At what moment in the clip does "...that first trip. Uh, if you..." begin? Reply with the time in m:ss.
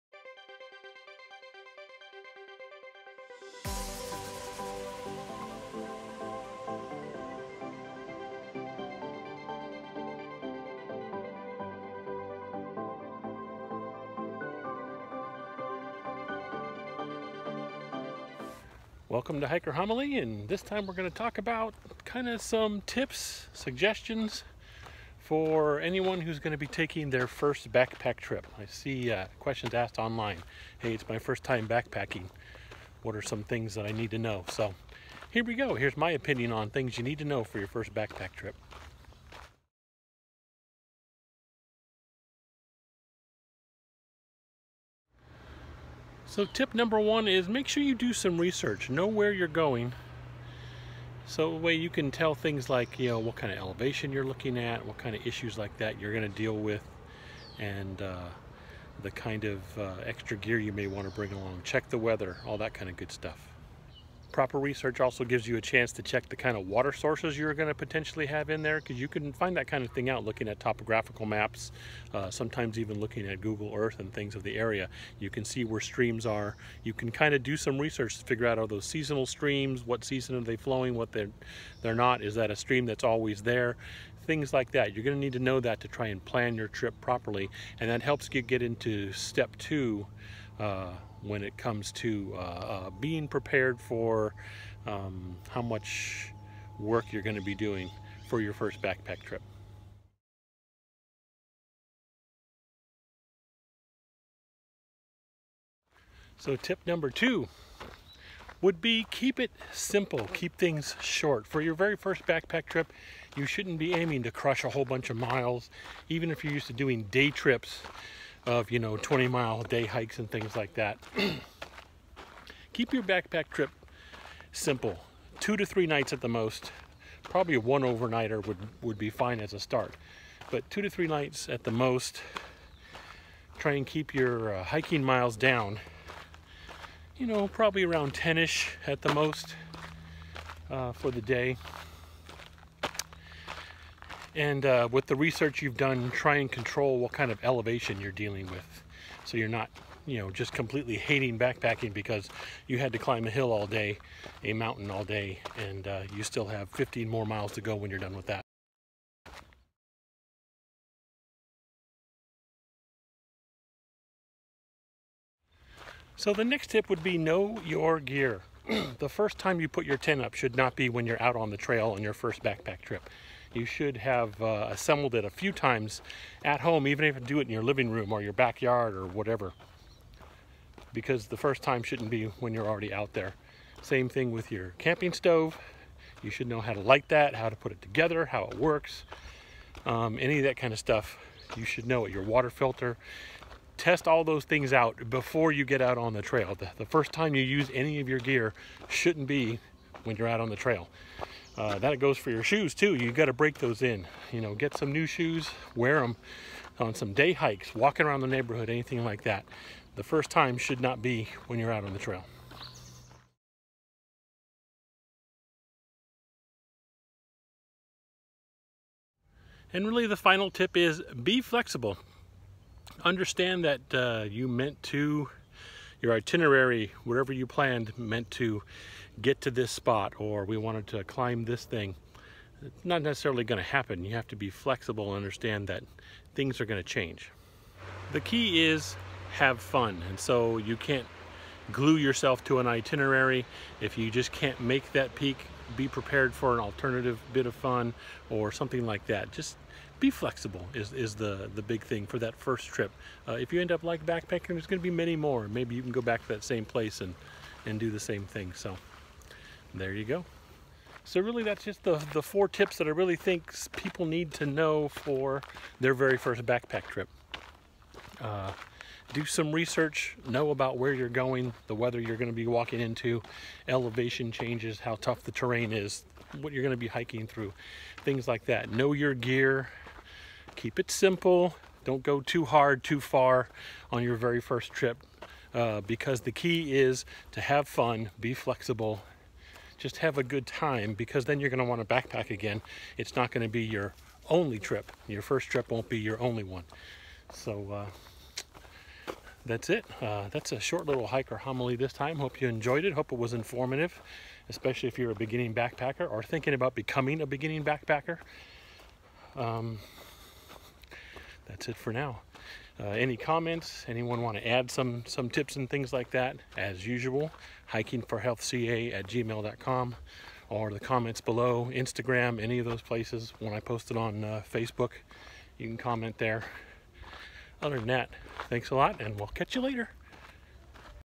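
4:12.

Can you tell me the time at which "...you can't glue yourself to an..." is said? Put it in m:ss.
4:00.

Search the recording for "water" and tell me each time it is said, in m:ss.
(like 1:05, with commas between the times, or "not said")
1:06, 3:12.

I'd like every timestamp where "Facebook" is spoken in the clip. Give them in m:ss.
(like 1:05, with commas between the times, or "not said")
5:24.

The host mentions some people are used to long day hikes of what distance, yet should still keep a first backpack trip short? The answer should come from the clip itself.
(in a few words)
20 miles.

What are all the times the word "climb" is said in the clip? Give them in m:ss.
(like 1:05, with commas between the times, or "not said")
2:32, 3:51.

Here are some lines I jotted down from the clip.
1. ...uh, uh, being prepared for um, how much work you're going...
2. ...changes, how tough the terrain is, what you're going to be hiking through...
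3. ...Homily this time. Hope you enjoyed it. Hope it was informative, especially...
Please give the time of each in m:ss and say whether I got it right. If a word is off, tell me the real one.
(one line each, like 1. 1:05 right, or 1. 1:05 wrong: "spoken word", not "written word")
1. 1:32 right
2. 4:34 right
3. 5:01 right.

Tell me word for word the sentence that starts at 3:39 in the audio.
And really the final tip is be flexible.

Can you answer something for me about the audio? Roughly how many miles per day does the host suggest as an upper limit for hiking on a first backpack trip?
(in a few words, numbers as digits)
10.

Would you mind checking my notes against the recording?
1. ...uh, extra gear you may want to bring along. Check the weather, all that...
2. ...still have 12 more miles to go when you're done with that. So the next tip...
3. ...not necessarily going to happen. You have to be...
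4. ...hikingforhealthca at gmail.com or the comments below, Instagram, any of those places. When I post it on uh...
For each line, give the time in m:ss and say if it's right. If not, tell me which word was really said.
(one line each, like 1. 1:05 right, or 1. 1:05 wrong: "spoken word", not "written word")
1. 0:59 right
2. 2:36 wrong: "15", not "12"
3. 3:52 right
4. 5:17 right.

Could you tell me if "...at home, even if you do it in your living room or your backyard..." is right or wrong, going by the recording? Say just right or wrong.
right.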